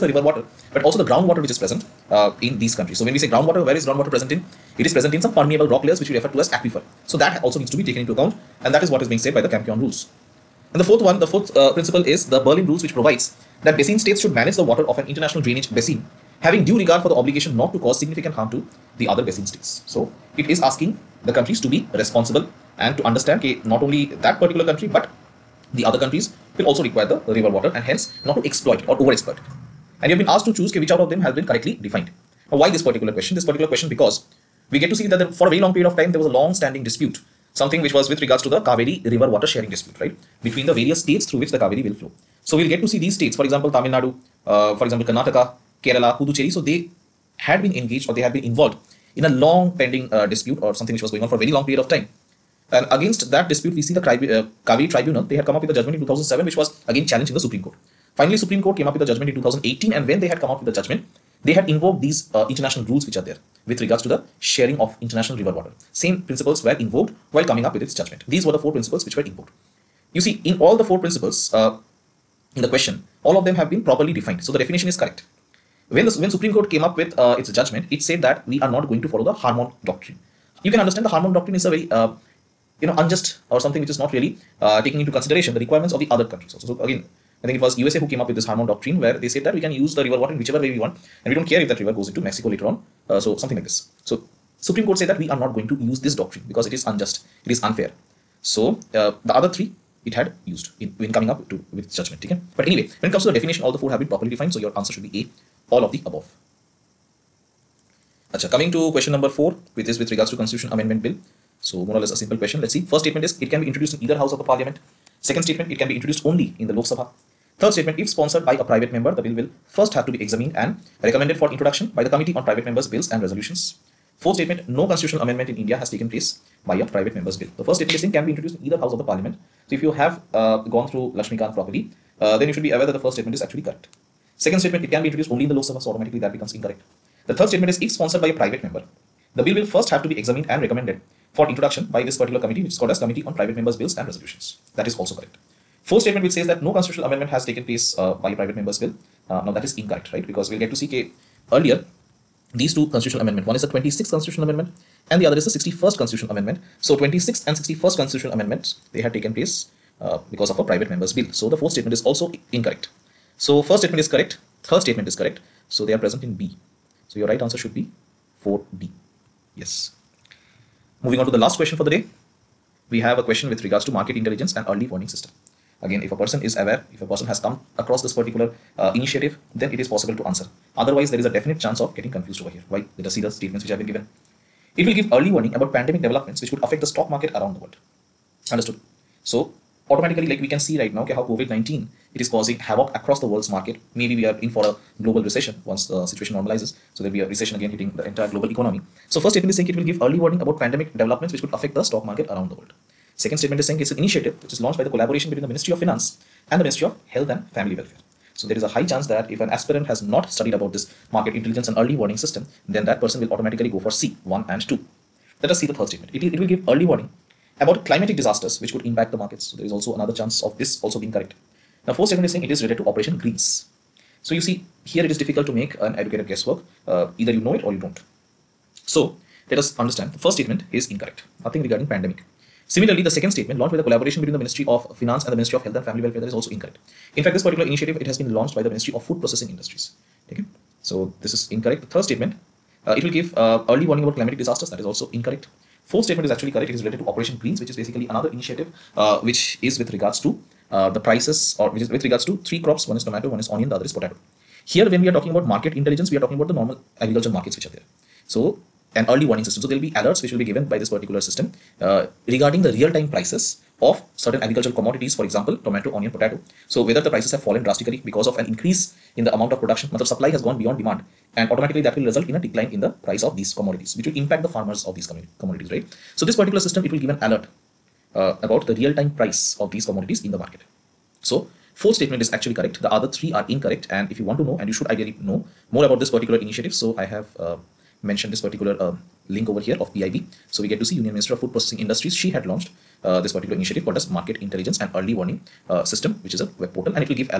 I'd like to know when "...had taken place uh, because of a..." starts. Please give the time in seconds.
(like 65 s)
158 s.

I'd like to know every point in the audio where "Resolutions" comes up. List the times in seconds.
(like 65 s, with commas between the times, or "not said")
123 s, 144 s.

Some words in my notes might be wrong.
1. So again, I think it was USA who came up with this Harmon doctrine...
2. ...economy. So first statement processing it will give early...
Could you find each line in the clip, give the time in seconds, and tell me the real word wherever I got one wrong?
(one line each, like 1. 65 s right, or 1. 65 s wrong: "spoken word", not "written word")
1. 86 s right
2. 198 s wrong: "saying", not "processing".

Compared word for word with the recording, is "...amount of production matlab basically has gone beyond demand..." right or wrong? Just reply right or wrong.
wrong.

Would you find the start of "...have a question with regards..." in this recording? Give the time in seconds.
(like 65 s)
172 s.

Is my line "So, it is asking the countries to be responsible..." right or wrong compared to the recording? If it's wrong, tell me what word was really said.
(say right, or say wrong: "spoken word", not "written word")
right.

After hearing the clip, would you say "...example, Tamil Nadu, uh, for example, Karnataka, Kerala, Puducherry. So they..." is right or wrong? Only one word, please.
right.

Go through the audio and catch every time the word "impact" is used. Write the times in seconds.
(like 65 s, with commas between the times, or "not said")
218 s, 274 s.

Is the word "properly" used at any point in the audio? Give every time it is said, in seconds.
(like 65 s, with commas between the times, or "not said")
73 s, 104 s, 131 s.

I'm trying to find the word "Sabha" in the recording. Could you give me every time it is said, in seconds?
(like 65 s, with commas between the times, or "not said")
116 s, 135 s.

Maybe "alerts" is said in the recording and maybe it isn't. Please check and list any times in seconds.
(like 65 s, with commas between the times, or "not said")
259 s, 277 s.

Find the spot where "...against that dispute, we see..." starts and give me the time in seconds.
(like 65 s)
52 s.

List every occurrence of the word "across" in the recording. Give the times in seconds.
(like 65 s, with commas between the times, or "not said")
177 s, 192 s.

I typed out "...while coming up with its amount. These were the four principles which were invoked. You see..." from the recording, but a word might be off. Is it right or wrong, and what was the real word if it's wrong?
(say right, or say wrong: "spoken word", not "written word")
wrong: "judgment", not "amount".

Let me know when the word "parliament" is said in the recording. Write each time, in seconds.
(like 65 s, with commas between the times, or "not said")
114 s, 129 s.